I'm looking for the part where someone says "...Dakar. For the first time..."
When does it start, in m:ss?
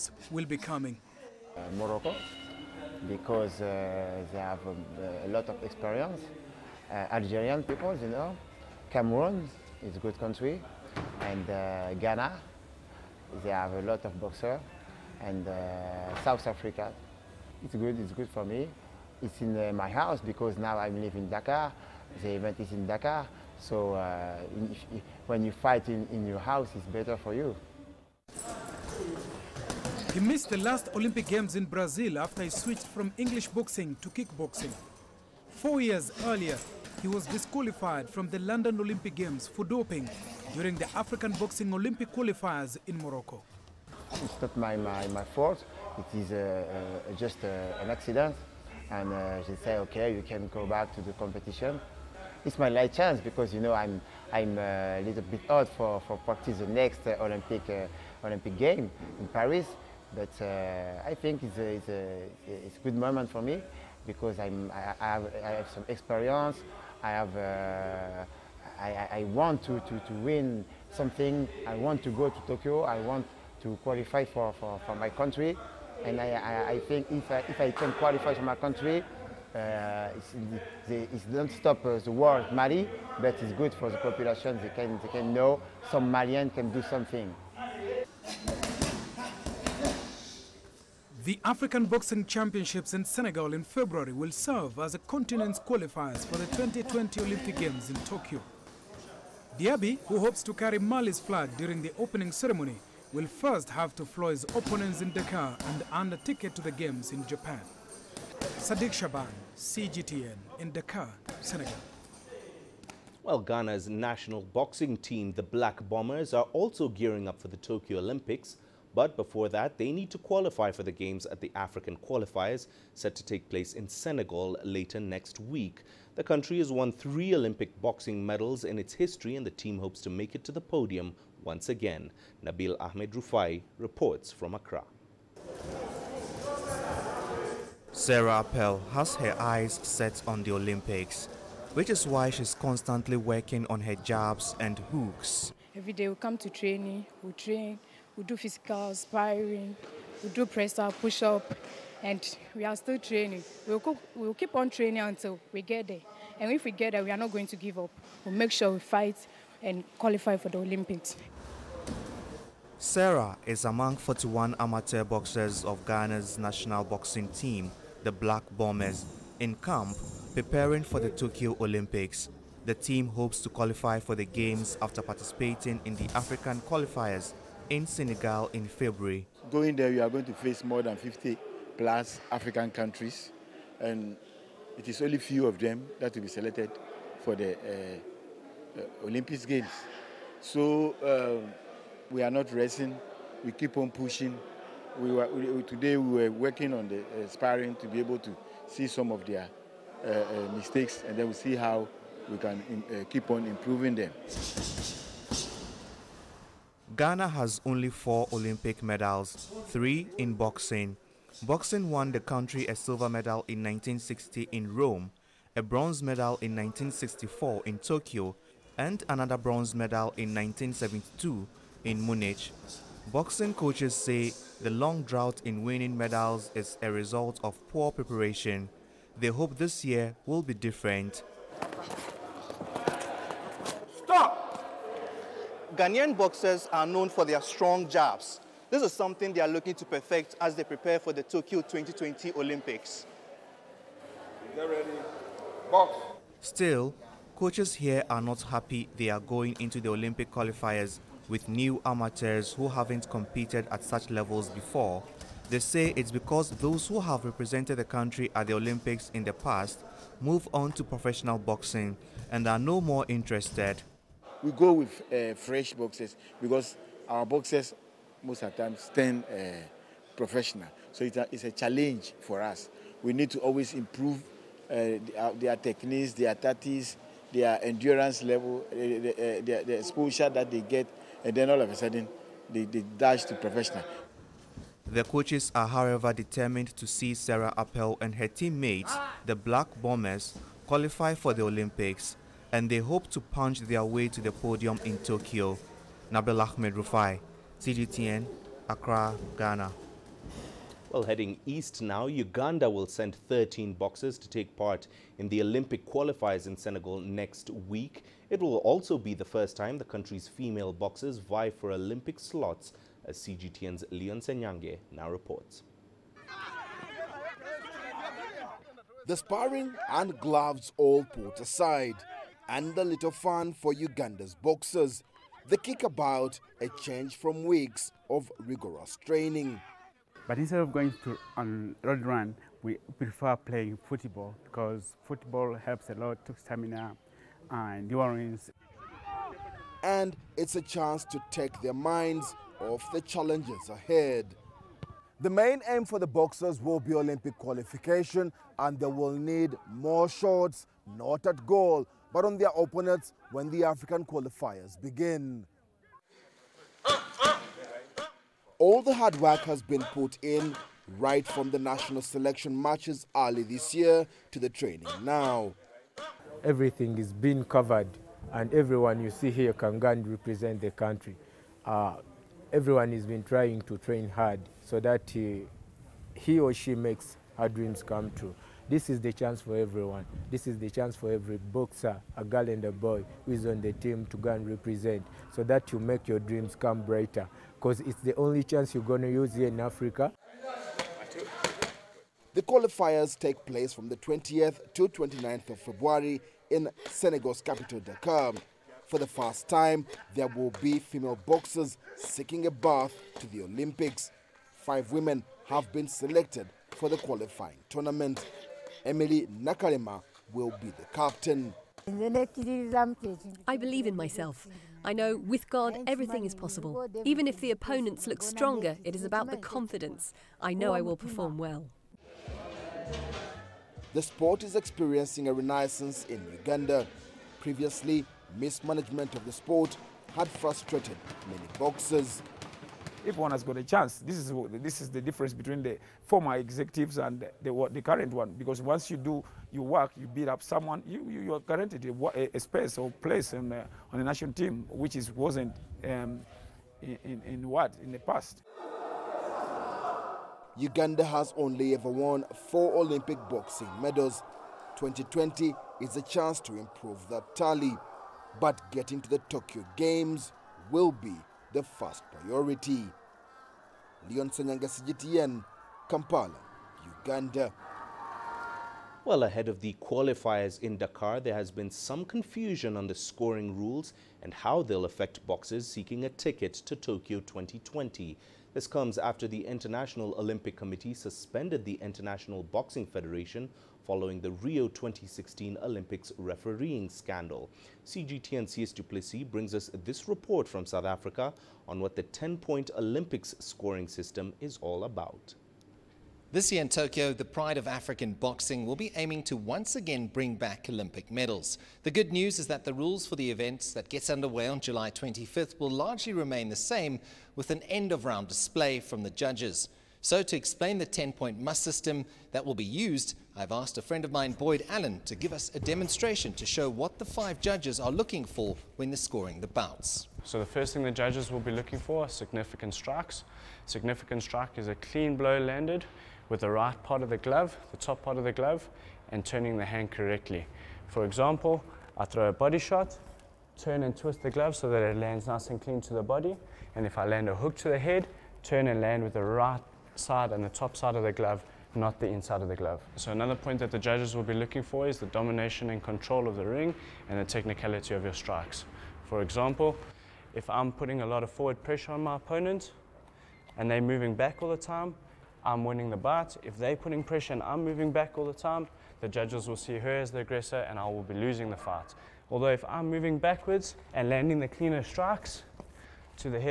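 6:37.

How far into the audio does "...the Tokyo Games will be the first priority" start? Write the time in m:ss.
7:39.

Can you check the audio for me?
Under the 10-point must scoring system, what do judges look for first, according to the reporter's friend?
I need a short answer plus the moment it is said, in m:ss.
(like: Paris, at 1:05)
Significant strikes, at 8:42.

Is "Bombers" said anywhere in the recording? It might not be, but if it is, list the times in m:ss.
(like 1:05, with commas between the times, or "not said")
1:55, 2:48, 4:49.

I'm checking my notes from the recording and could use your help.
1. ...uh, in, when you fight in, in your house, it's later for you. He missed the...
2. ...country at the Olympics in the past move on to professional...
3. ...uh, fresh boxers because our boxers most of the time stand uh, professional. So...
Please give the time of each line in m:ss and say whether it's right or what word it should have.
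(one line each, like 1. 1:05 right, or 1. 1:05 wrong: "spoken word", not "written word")
1. 0:23 wrong: "better", not "later"
2. 4:17 right
3. 4:25 right.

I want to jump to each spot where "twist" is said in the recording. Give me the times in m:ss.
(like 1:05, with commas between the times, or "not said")
8:53.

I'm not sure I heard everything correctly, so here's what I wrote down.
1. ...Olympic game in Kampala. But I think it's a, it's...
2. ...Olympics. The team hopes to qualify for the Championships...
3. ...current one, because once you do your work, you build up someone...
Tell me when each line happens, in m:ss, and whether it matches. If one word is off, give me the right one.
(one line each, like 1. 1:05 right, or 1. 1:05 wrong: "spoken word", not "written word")
1. 0:58 wrong: "Paris", not "Kampala"
2. 2:51 wrong: "Games", not "Championships"
3. 7:17 right.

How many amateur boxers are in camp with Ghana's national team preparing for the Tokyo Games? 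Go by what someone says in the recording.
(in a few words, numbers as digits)
41.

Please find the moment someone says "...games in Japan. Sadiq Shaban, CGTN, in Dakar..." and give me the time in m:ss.
1:46.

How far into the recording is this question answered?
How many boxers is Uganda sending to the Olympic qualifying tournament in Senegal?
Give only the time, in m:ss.
5:03.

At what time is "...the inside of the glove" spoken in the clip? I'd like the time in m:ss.
9:01.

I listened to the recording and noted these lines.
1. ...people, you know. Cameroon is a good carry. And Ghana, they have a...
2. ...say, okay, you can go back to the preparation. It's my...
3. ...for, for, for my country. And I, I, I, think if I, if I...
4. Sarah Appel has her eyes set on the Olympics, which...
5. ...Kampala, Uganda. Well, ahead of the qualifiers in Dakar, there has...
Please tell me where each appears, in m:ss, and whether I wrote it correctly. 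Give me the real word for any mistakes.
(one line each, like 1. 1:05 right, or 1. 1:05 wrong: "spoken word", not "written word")
1. 0:07 wrong: "country", not "carry"
2. 0:49 wrong: "competition", not "preparation"
3. 1:14 right
4. 2:17 right
5. 7:45 right.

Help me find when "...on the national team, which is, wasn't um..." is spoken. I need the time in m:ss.
7:23.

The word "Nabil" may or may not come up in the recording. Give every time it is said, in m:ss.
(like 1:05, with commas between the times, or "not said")
2:12, 4:56.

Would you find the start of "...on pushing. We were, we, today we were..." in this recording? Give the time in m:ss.
3:13.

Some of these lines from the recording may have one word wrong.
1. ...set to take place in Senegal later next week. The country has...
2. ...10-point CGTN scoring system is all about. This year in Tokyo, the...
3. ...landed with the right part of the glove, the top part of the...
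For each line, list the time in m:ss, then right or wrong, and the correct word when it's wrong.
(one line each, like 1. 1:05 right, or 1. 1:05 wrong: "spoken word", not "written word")
1. 2:02 right
2. 8:12 wrong: "Olympics", not "CGTN"
3. 8:45 right.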